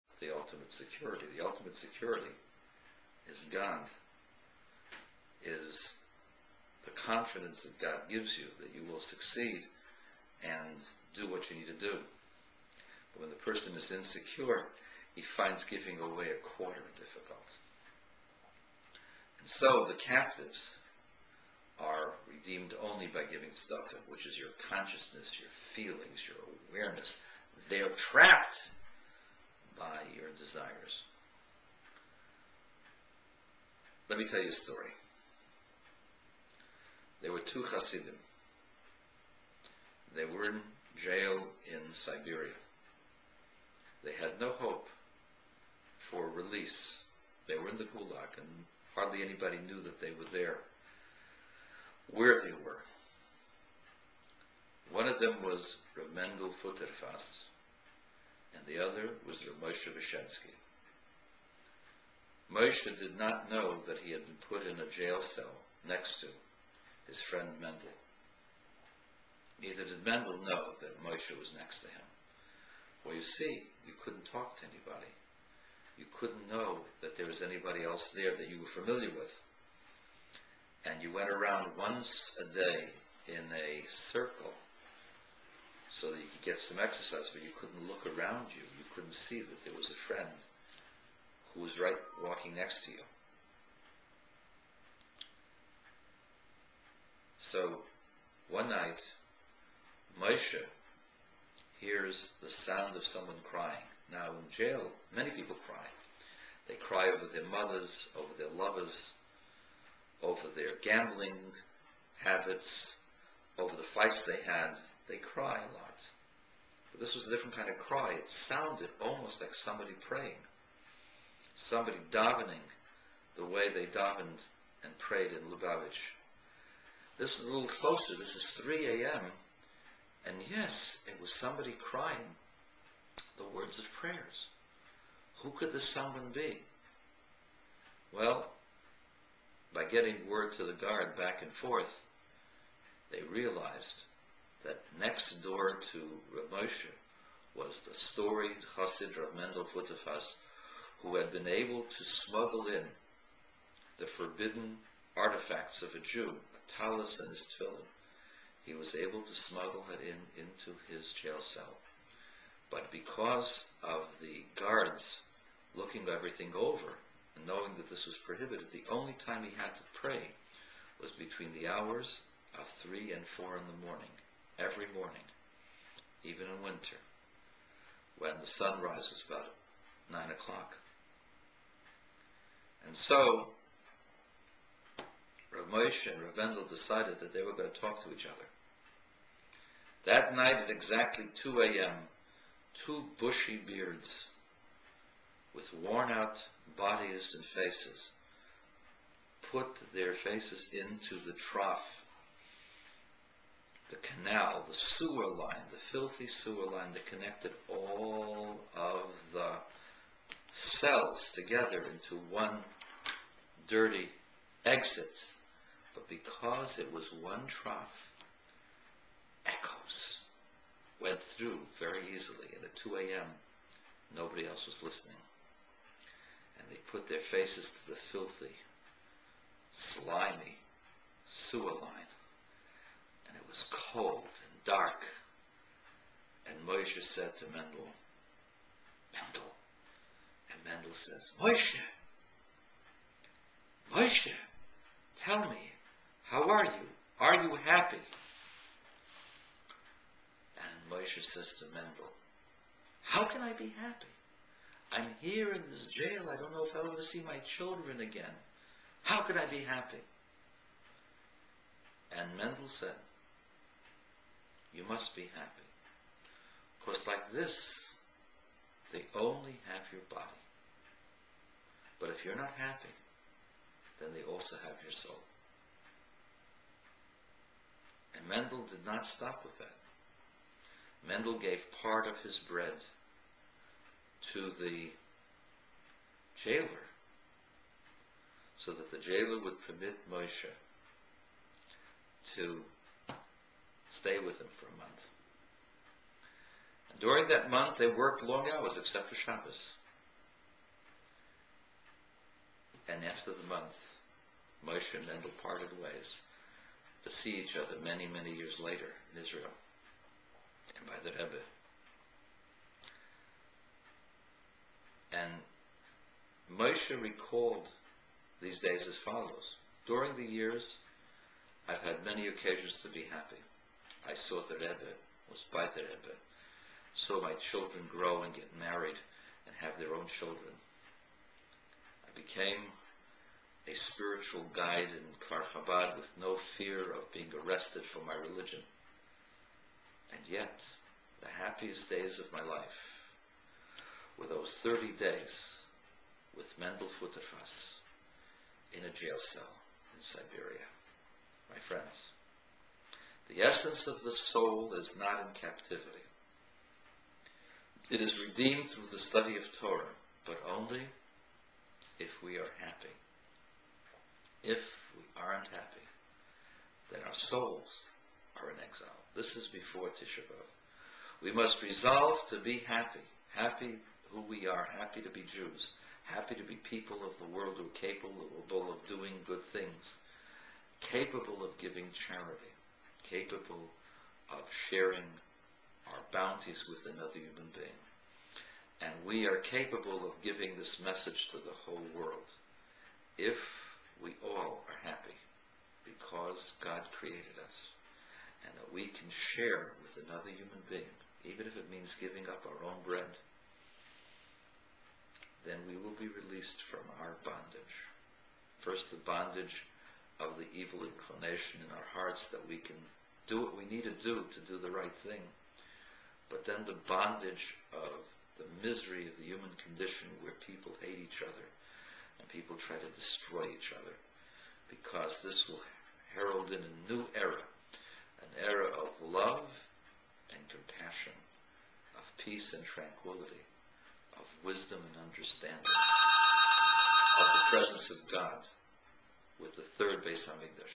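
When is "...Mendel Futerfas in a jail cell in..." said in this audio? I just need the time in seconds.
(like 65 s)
346 s.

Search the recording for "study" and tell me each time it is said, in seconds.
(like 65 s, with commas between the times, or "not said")
358 s.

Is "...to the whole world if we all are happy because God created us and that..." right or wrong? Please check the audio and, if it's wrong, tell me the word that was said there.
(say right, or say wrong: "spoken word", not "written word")
right.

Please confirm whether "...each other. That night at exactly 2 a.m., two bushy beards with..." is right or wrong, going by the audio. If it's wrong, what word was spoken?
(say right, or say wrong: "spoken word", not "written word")
right.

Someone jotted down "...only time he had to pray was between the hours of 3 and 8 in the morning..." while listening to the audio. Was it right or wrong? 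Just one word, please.
wrong.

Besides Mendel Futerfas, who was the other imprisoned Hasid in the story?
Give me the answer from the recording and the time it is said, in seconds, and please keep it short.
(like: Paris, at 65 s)
Moshe Beshensky, at 59 s.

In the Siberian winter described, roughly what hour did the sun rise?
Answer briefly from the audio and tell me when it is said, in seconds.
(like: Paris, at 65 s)
9 o'clock, at 180 s.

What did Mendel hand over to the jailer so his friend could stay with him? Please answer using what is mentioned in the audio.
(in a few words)
Part of his bread.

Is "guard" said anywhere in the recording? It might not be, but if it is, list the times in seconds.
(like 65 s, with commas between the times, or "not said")
140 s, 164 s.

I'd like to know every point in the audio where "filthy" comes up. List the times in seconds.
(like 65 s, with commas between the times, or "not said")
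205 s, 228 s.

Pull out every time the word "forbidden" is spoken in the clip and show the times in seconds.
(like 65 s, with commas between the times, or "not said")
154 s.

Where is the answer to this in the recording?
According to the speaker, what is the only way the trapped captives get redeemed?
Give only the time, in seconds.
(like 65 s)
23 s.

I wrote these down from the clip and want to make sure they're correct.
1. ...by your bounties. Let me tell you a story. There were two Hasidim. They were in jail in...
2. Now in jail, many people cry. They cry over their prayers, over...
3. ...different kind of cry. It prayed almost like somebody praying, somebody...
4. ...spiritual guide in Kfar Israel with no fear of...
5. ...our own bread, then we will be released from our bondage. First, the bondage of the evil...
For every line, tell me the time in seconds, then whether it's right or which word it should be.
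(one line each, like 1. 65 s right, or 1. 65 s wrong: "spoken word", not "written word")
1. 29 s wrong: "desires", not "bounties"
2. 104 s wrong: "mothers", not "prayers"
3. 117 s wrong: "sounded", not "prayed"
4. 333 s wrong: "Chabad", not "Israel"
5. 402 s right.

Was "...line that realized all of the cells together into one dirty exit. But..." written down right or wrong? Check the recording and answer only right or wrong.
wrong.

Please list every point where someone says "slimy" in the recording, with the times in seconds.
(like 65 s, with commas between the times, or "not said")
229 s.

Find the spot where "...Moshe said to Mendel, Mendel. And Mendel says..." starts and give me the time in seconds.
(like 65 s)
236 s.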